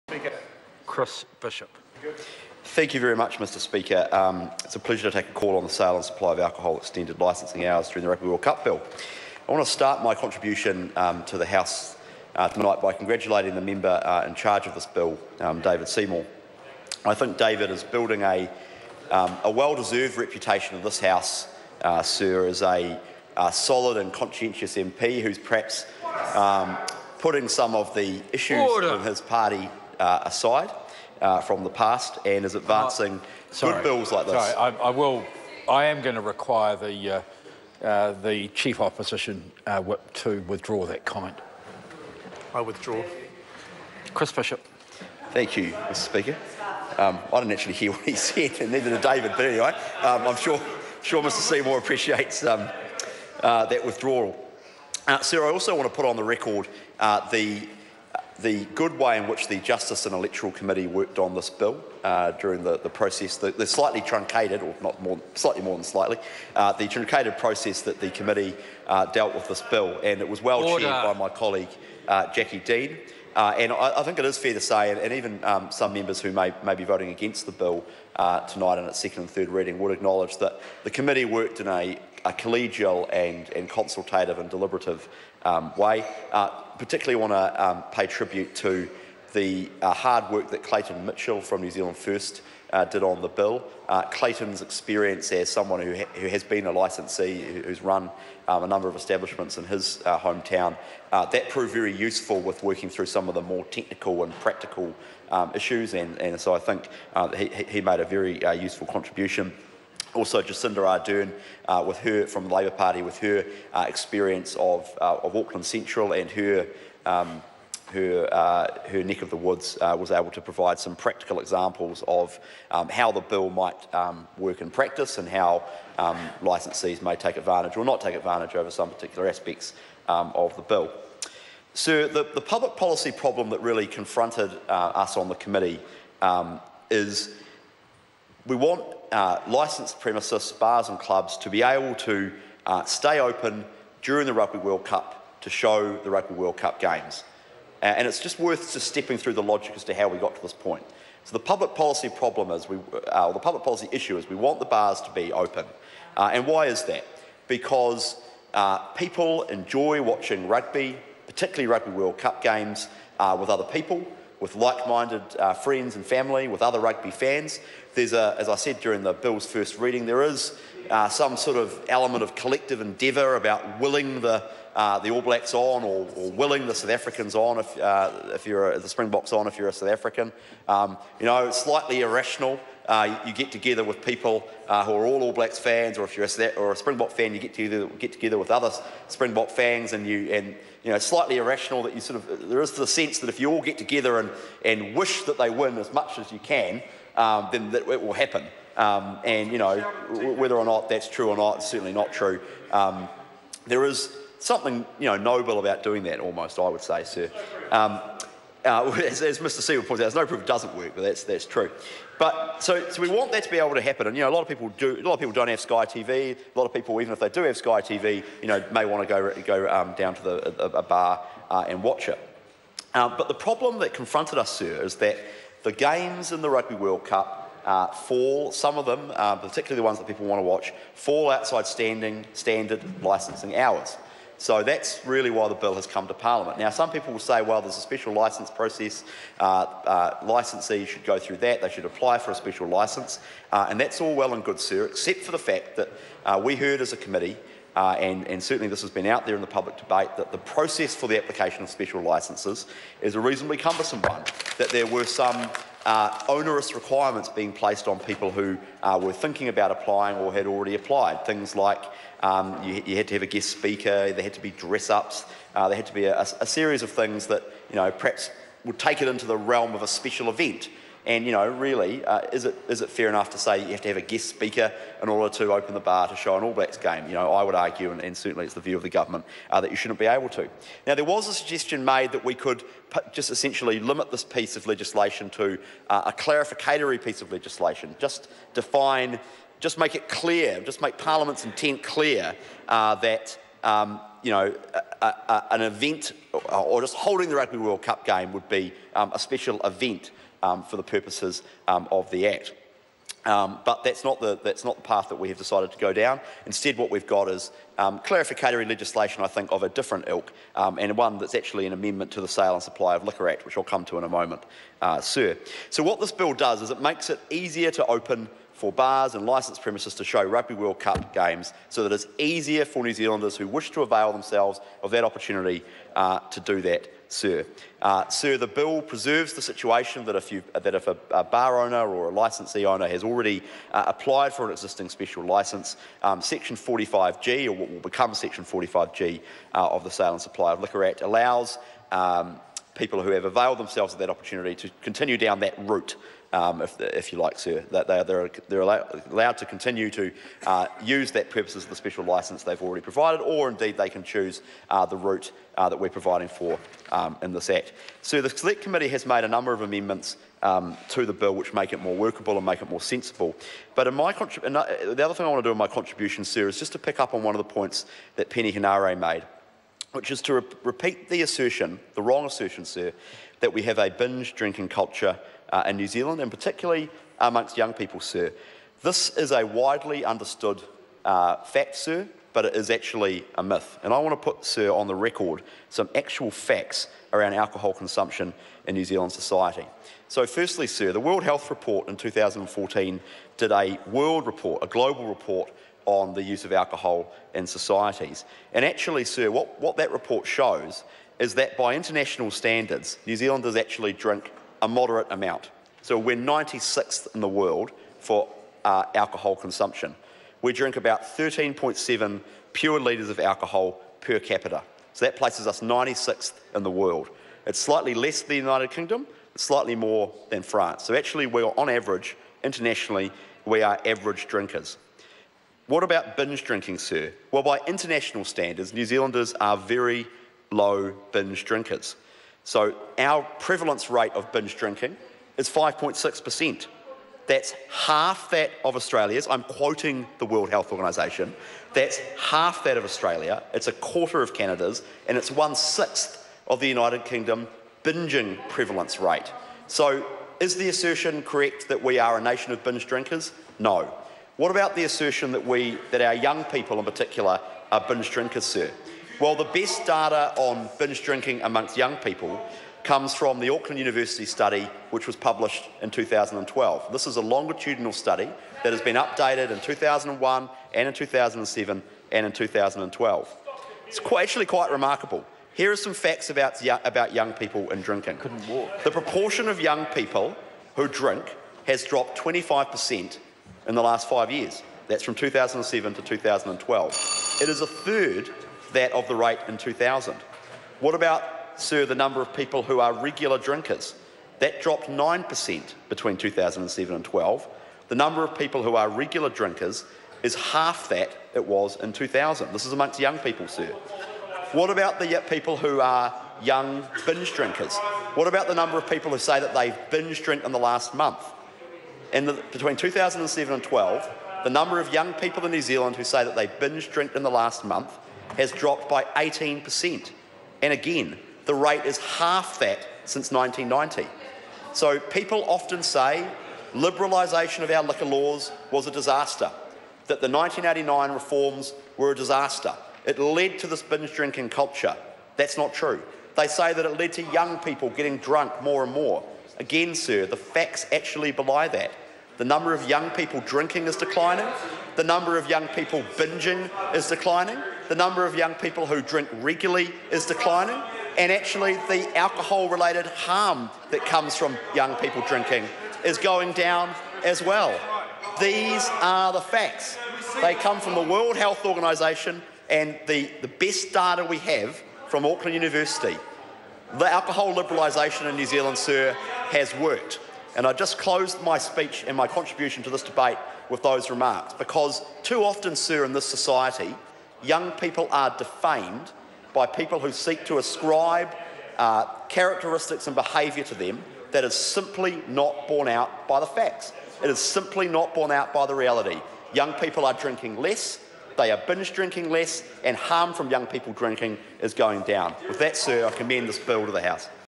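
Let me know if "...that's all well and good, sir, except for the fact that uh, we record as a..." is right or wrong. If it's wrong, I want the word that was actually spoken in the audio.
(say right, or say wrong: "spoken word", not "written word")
wrong: "heard", not "record".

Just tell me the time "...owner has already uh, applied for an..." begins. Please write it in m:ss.
5:32.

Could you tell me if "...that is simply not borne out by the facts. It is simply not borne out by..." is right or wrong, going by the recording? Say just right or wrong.
right.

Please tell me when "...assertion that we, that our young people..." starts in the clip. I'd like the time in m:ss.
7:34.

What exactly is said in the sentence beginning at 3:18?
Um, and you know whether or not that's true or not, it's certainly not true.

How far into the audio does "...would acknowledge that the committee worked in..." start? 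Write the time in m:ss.
1:19.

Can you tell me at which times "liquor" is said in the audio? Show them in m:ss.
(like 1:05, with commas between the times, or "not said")
5:13, 5:40, 8:47.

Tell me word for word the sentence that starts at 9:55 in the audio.
With that, sir, I commend this bill to the House.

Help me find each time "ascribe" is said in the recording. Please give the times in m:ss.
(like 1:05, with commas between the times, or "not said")
9:40.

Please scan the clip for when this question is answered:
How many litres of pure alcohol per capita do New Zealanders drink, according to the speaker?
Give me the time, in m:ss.
6:51.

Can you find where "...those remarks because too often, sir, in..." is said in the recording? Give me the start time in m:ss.
9:33.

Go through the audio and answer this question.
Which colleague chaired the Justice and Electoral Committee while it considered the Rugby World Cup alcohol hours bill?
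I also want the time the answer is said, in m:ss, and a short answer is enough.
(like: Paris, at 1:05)
Jacqui Dean, at 1:12.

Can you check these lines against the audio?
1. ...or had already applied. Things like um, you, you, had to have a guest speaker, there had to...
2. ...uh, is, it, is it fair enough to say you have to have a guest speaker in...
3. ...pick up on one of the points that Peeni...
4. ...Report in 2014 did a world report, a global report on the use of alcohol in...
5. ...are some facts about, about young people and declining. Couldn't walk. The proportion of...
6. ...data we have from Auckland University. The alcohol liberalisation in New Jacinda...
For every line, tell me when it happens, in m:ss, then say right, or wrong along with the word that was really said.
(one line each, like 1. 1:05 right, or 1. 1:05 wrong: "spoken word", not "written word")
1. 4:20 right
2. 4:32 right
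3. 6:06 right
4. 6:31 right
5. 7:55 wrong: "drinking", not "declining"
6. 9:23 wrong: "Zealand", not "Jacinda".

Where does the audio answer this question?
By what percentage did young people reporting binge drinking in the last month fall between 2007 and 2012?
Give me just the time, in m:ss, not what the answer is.
8:39.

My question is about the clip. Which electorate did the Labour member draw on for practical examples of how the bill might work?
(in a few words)
Auckland Central.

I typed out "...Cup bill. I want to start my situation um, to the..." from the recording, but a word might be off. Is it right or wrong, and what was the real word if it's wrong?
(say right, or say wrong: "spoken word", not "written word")
wrong: "contribution", not "situation".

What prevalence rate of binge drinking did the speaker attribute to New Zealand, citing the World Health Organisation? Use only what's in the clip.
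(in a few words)
5.6%.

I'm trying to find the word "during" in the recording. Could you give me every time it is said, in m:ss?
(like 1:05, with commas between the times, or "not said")
0:07, 1:02, 2:24, 2:48.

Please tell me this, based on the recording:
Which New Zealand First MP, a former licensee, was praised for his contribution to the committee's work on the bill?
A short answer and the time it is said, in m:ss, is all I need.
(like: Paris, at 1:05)
Clayton Mitchell, at 1:30.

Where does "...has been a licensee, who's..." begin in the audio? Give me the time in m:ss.
1:36.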